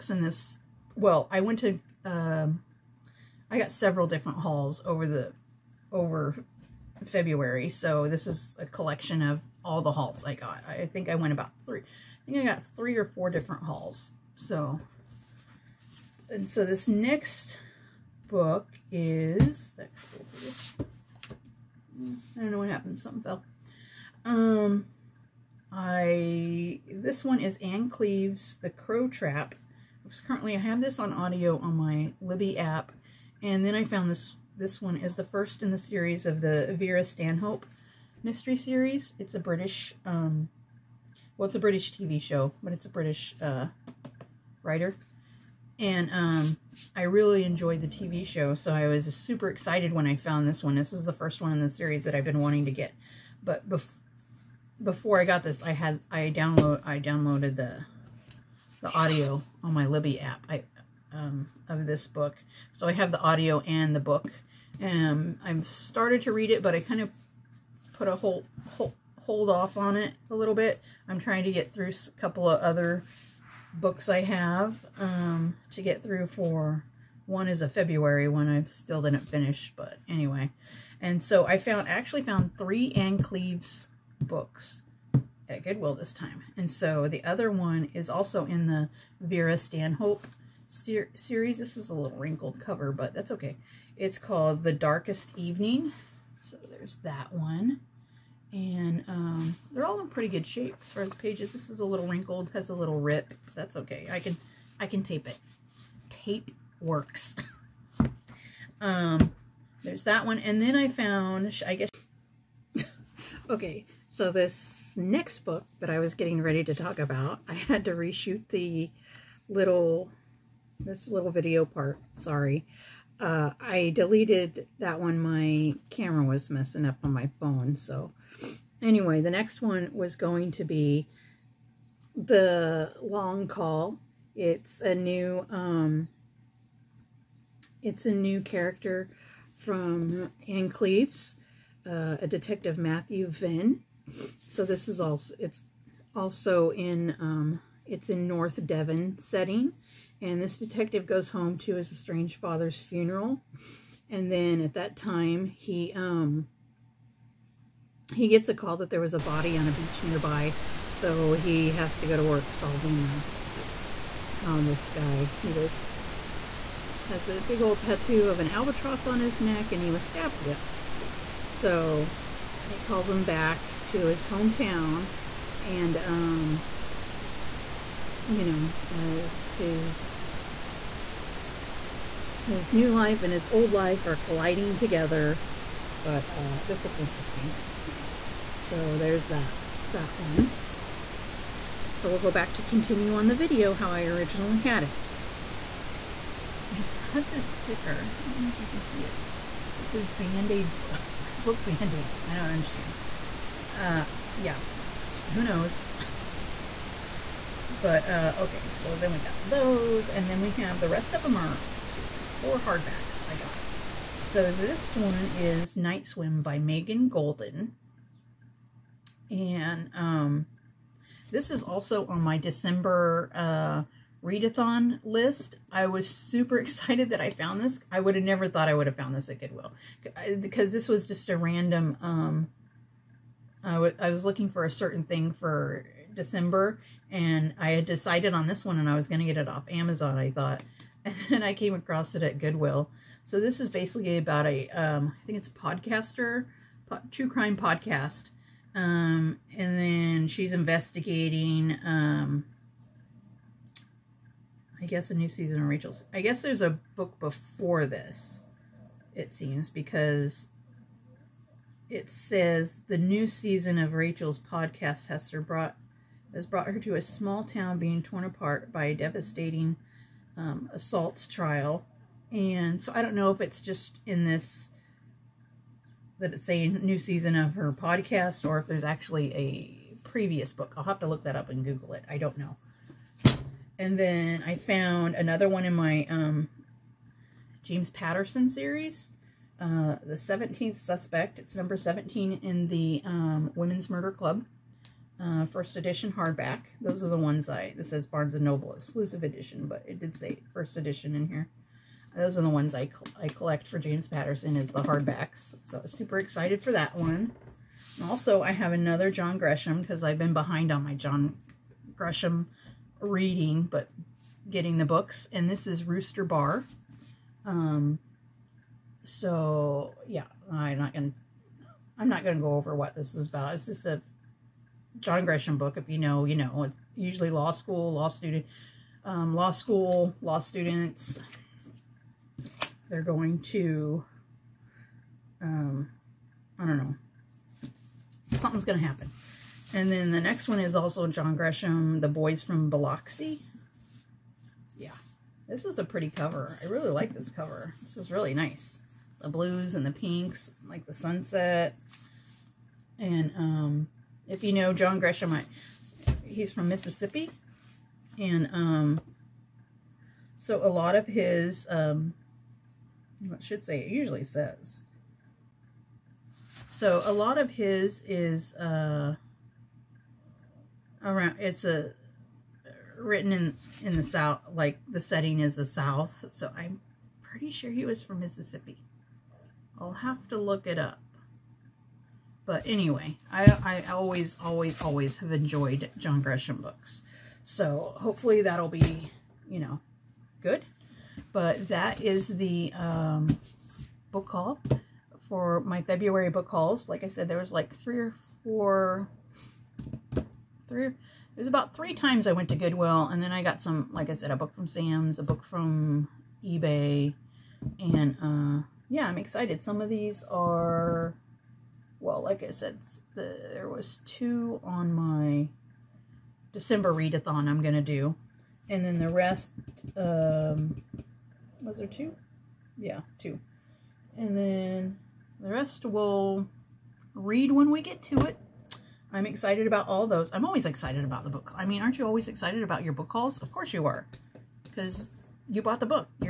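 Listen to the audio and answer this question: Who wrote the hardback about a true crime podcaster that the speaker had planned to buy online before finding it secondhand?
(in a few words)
Megan Goldin.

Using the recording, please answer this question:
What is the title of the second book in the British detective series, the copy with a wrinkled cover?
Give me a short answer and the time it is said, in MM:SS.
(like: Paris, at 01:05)
The Darkest Evening, at 01:34.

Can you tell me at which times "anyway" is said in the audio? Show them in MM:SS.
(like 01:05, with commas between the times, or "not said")
01:20, 02:08, 06:22.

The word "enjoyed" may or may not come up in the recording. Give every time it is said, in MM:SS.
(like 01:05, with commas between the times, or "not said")
00:47, 06:25.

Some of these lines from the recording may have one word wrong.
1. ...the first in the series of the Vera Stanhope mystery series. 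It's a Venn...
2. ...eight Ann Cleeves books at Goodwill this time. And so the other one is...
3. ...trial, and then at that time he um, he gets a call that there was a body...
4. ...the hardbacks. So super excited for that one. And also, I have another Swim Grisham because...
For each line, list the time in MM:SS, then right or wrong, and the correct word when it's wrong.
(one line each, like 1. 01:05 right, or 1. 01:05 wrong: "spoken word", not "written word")
1. 00:35 wrong: "British", not "Venn"
2. 01:22 wrong: "three", not "eight"
3. 02:32 wrong: "funeral", not "trial"
4. 05:04 wrong: "John", not "Swim".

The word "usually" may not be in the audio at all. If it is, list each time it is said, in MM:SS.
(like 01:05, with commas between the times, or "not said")
05:26, 06:03.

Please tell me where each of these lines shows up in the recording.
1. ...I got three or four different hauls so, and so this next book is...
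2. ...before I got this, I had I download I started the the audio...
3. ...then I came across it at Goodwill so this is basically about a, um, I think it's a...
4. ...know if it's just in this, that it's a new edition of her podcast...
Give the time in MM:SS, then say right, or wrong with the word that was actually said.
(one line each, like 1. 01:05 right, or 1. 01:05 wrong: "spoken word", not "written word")
1. 00:12 right
2. 00:54 wrong: "downloaded", not "started"
3. 04:01 right
4. 04:33 wrong: "season", not "edition".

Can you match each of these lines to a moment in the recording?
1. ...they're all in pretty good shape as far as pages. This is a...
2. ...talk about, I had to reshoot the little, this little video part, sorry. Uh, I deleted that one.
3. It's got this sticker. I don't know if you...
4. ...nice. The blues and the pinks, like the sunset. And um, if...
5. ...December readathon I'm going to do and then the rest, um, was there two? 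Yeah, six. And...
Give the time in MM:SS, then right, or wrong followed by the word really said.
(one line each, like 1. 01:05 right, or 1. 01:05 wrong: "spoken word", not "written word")
1. 01:39 right
2. 01:56 right
3. 03:16 right
4. 05:48 right
5. 06:56 wrong: "two", not "six".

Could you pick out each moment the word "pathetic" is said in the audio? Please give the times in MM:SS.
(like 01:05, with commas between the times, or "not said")
not said.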